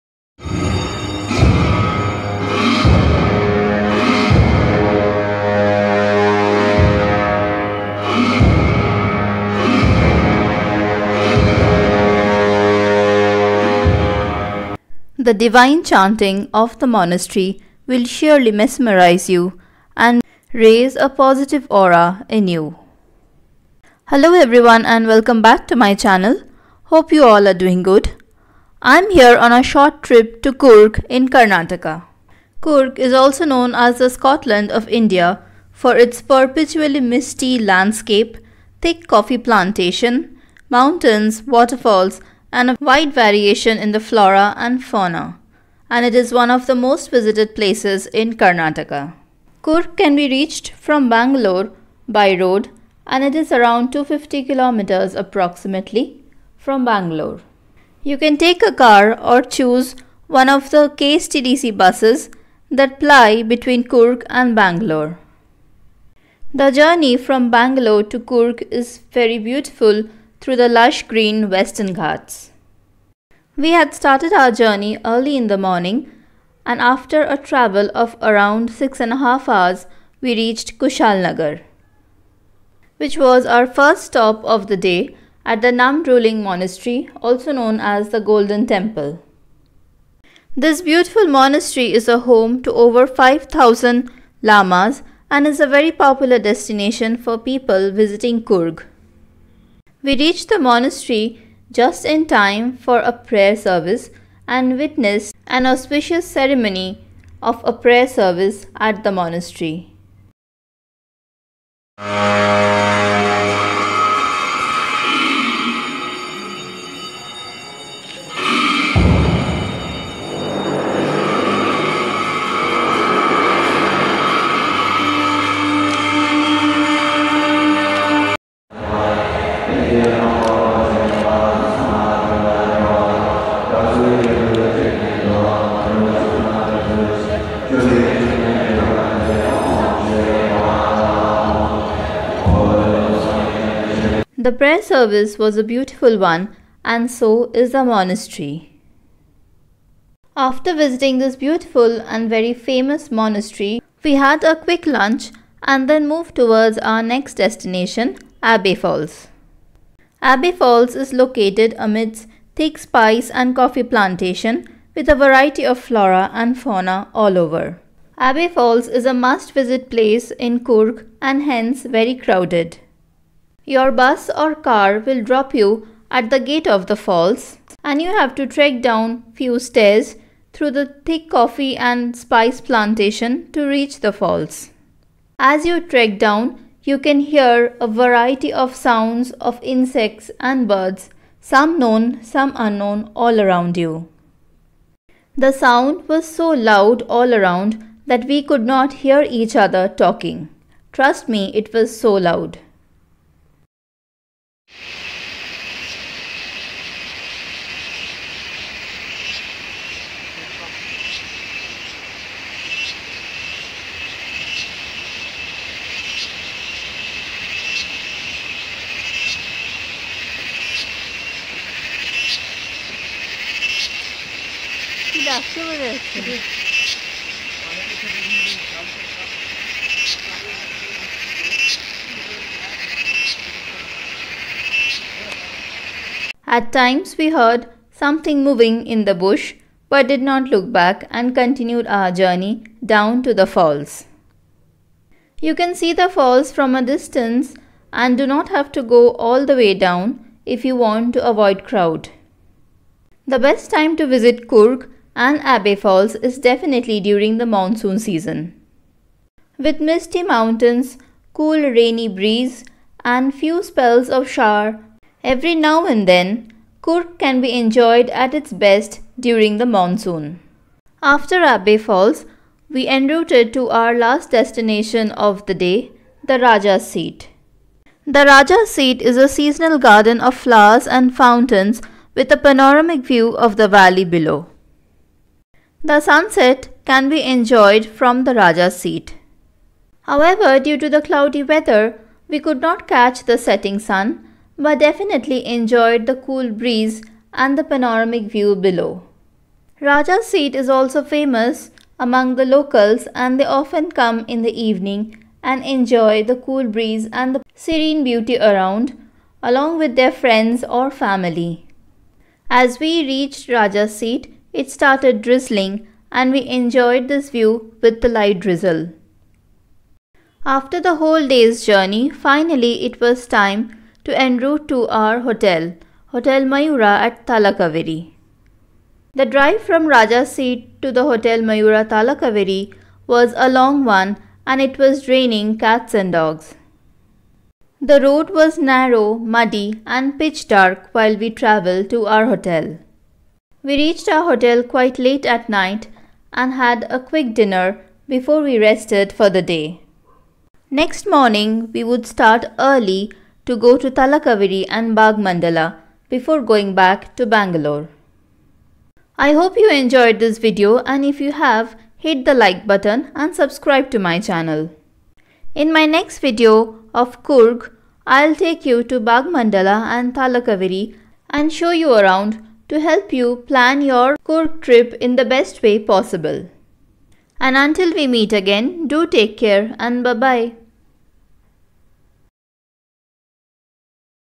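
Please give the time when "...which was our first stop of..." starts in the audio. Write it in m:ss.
1:22.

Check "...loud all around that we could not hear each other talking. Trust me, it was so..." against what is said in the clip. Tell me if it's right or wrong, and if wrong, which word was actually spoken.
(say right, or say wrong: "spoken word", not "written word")
right.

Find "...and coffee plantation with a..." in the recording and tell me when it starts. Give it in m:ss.
2:43.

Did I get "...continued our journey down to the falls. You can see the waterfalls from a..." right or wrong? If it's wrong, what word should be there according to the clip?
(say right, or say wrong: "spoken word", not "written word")
wrong: "falls", not "waterfalls".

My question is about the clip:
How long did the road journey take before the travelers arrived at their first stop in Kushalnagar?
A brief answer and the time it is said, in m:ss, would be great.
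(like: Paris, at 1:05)
six and a half hours, at 1:18.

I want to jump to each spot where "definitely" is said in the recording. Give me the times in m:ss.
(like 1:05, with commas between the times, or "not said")
4:16, 4:54.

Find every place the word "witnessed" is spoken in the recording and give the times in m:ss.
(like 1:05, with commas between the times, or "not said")
1:44.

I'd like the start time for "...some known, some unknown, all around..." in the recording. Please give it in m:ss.
3:11.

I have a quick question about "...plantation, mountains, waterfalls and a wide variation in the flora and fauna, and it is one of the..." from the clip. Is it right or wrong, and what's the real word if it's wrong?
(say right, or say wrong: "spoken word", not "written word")
right.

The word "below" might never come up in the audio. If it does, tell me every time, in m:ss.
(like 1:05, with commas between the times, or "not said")
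4:44, 4:58.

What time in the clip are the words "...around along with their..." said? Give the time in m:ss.
5:08.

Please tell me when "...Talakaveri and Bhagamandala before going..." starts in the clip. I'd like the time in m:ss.
5:53.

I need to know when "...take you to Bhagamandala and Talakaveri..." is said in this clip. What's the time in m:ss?
6:08.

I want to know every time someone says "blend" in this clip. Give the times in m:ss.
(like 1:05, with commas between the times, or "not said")
not said.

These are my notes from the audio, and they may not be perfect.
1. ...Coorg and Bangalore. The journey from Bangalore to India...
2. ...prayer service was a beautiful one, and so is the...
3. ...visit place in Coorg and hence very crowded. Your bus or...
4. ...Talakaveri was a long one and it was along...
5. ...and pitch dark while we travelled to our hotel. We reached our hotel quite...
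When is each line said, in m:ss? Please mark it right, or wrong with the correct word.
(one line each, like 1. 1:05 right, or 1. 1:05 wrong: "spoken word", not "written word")
1. 1:03 wrong: "Coorg", not "India"
2. 2:24 right
3. 2:49 right
4. 5:31 wrong: "draining", not "along"
5. 5:39 right.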